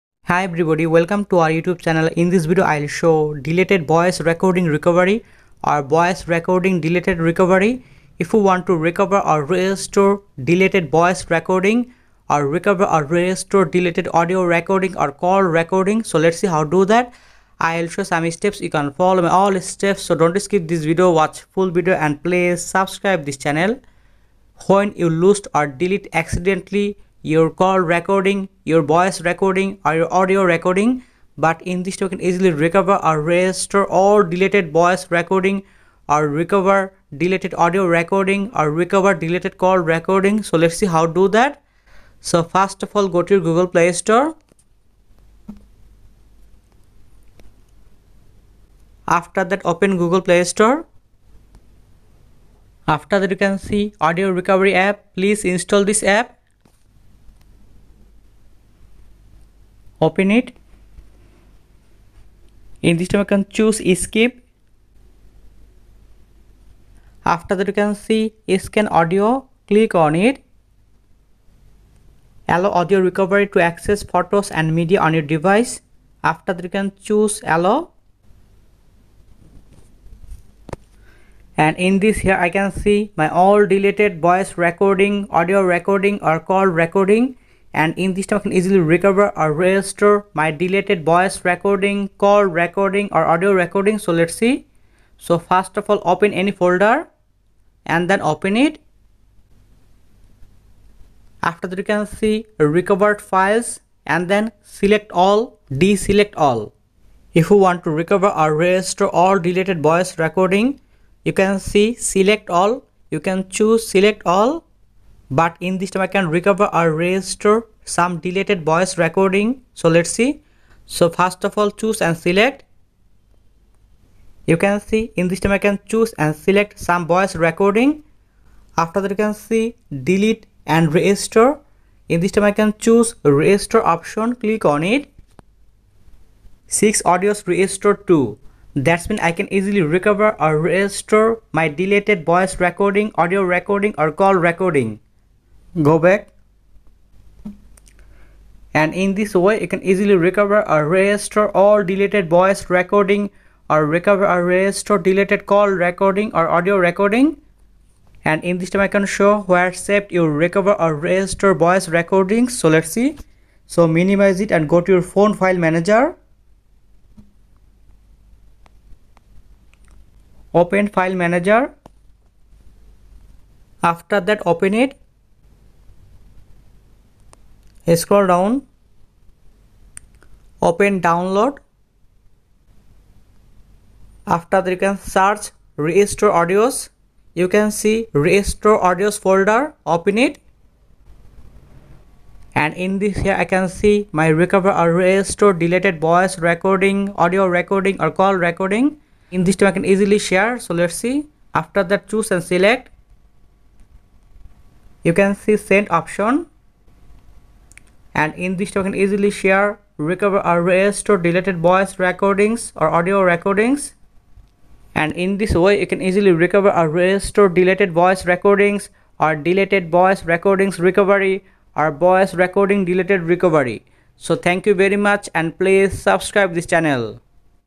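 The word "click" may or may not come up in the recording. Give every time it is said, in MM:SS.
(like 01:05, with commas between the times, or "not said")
01:09, 02:14.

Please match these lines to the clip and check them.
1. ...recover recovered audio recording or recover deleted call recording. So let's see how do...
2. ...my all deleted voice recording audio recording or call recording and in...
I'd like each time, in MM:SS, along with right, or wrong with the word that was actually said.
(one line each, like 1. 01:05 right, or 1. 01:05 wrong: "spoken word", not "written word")
1. 00:36 wrong: "deleted", not "recovered"
2. 01:23 right.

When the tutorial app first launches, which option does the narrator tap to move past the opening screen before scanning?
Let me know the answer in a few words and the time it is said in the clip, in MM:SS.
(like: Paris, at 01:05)
Skip, at 01:03.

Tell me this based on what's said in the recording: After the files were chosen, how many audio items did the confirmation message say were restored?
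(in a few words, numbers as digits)
6.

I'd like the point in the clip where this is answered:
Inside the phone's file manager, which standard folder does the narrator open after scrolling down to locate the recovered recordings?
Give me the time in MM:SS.
03:00.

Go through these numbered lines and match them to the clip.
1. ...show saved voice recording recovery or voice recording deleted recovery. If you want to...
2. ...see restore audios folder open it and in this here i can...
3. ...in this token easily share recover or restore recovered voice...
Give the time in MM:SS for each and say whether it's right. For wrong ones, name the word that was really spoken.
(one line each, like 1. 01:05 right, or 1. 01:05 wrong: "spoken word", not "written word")
1. 00:02 wrong: "deleted", not "saved"
2. 03:07 right
3. 03:28 wrong: "deleted", not "recovered".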